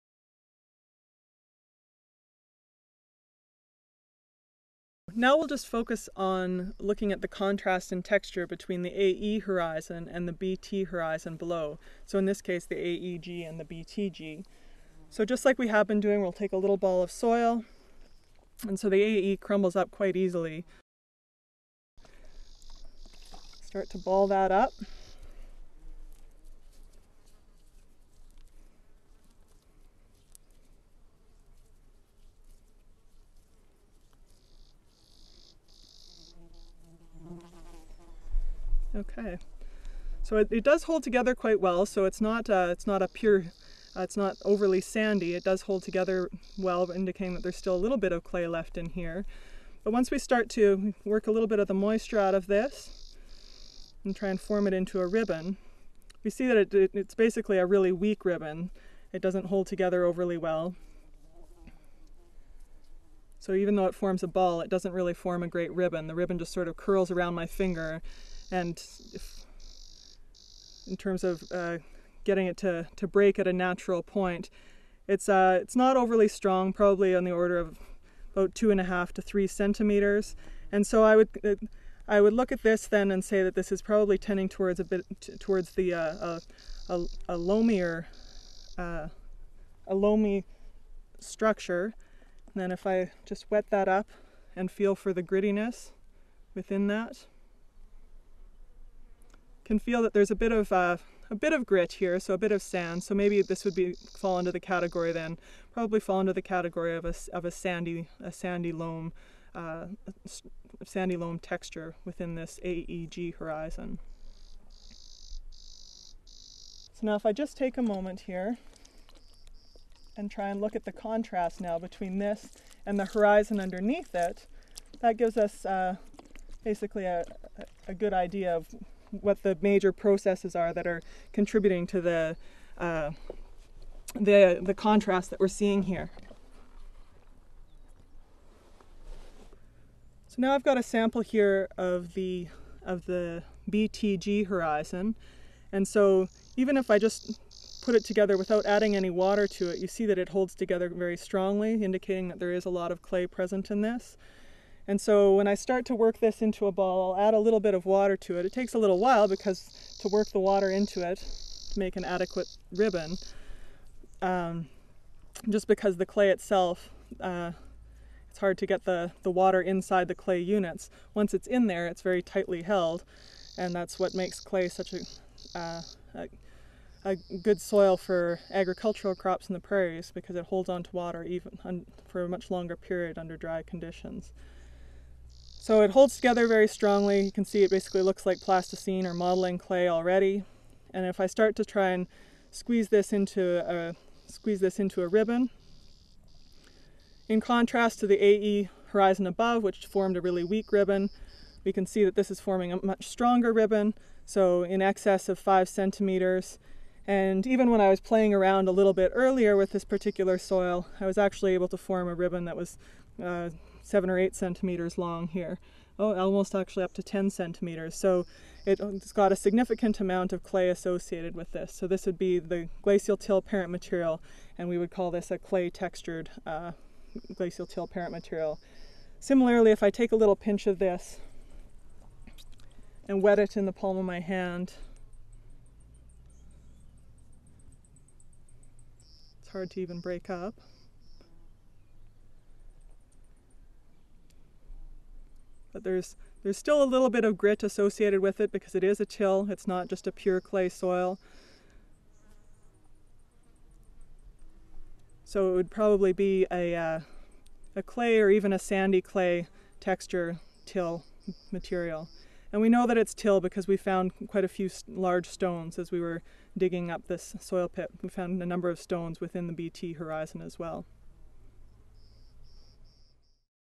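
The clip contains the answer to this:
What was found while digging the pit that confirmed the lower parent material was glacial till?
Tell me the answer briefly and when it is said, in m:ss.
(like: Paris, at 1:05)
large stones, at 4:24.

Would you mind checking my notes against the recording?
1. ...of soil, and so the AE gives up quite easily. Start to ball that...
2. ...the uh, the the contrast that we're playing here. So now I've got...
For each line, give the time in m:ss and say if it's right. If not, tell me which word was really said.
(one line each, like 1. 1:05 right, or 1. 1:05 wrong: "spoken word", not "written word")
1. 0:17 wrong: "crumbles", not "gives"
2. 2:12 wrong: "seeing", not "playing".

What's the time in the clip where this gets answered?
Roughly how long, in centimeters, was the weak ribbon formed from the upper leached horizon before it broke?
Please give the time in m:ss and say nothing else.
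1:18.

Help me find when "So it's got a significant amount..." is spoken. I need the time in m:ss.
3:37.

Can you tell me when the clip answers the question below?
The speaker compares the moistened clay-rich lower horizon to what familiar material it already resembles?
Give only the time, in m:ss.
3:08.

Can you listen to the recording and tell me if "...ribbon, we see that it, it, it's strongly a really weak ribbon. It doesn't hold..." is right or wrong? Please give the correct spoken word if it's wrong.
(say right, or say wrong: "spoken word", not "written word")
wrong: "basically", not "strongly".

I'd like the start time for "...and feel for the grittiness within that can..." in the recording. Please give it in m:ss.
1:34.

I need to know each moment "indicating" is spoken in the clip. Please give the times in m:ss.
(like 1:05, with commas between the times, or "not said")
0:46, 2:31.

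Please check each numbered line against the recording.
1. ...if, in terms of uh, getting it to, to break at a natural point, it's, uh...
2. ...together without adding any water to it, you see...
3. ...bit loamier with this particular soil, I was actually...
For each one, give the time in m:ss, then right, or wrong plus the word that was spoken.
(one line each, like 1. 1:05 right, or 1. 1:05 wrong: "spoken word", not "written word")
1. 1:09 right
2. 2:28 right
3. 3:28 wrong: "earlier", not "loamier".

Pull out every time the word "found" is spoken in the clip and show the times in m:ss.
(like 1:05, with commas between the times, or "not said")
4:23, 4:28.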